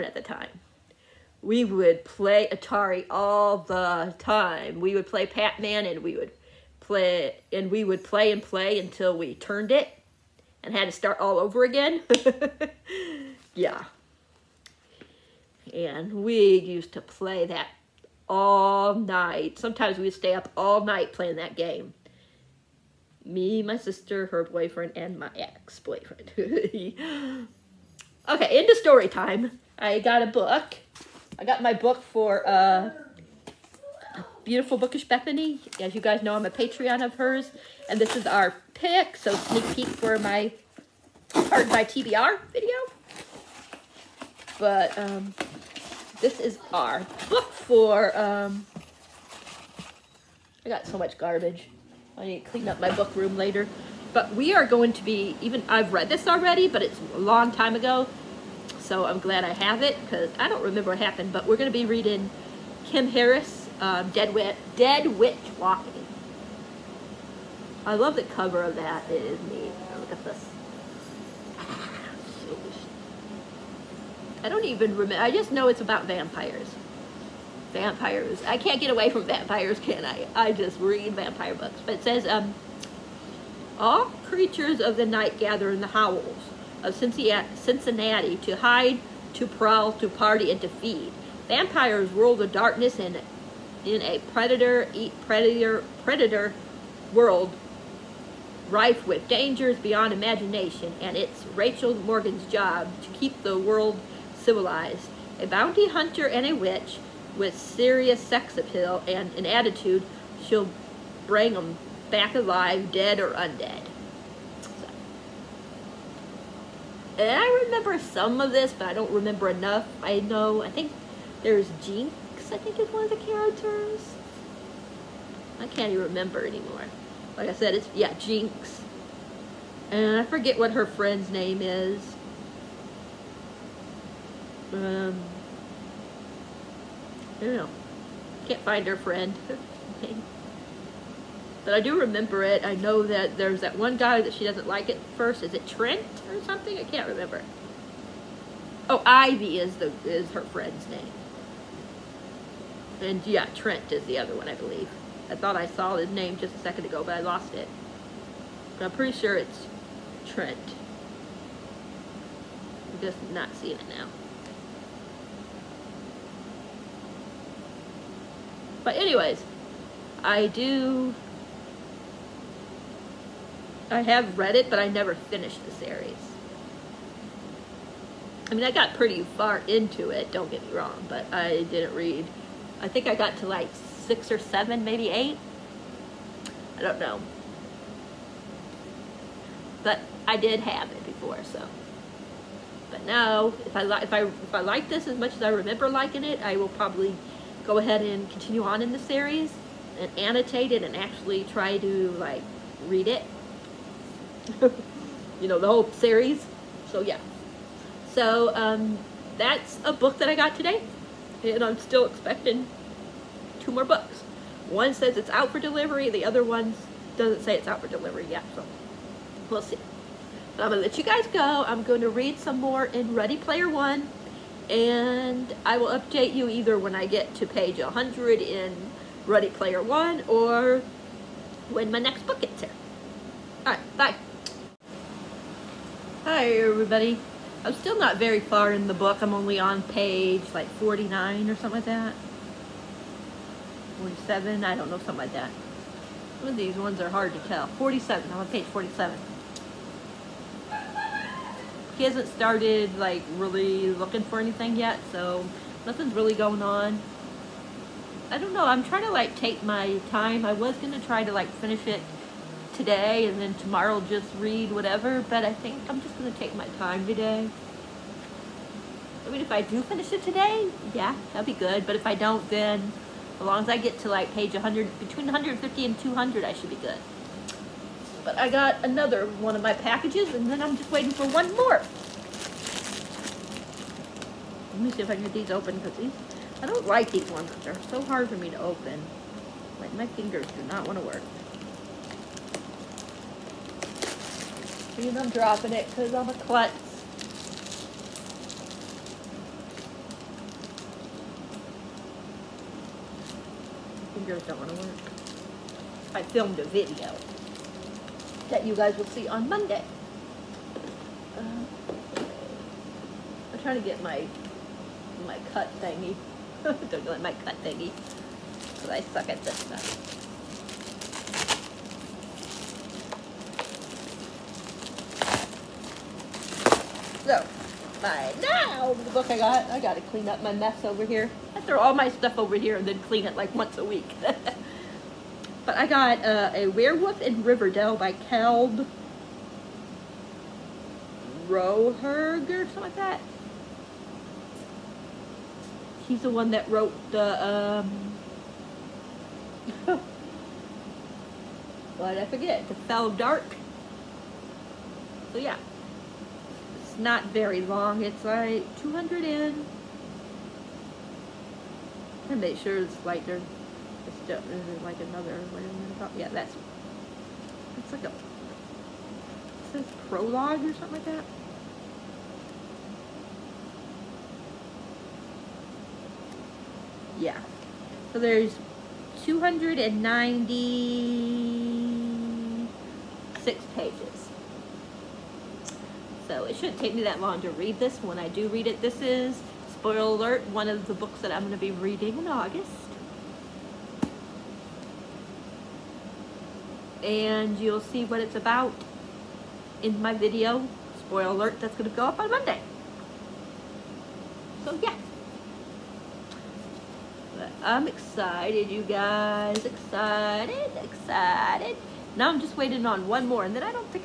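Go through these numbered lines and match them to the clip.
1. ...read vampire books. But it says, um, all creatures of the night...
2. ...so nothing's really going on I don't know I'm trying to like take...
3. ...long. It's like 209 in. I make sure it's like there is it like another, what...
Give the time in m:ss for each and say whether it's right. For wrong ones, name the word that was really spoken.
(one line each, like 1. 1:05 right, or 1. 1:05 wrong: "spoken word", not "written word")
1. 1:20 right
2. 4:15 right
3. 5:57 wrong: "200", not "209".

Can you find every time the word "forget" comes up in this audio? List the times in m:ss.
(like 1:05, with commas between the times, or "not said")
2:10, 5:52.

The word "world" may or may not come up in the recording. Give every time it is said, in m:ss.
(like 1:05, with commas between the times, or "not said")
1:37, 1:43.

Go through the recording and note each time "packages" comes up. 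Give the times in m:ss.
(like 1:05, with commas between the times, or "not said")
4:39.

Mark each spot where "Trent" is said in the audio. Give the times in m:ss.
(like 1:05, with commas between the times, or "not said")
2:25, 2:33, 2:40.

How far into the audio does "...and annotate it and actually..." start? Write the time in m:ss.
3:19.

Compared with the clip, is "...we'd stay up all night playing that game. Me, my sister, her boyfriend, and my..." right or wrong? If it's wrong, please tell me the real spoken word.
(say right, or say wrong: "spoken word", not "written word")
right.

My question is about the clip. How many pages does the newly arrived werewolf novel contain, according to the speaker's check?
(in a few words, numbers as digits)
296.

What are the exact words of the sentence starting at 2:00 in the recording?
I know, I think there's Jenks, I think is one of the characters.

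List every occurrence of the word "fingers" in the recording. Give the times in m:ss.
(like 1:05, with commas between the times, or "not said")
4:50, 5:04.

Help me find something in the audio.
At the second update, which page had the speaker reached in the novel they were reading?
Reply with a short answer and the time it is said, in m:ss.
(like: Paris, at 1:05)
47, at 4:07.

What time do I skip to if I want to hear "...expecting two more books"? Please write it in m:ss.
3:32.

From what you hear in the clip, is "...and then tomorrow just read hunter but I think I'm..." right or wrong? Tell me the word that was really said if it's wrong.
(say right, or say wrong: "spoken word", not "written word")
wrong: "whatever", not "hunter".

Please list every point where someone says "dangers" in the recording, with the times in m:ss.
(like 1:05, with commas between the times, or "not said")
1:39.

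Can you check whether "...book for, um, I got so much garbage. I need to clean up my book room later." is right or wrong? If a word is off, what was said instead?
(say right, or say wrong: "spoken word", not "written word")
right.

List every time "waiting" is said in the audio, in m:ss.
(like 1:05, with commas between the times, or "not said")
4:40, 6:52.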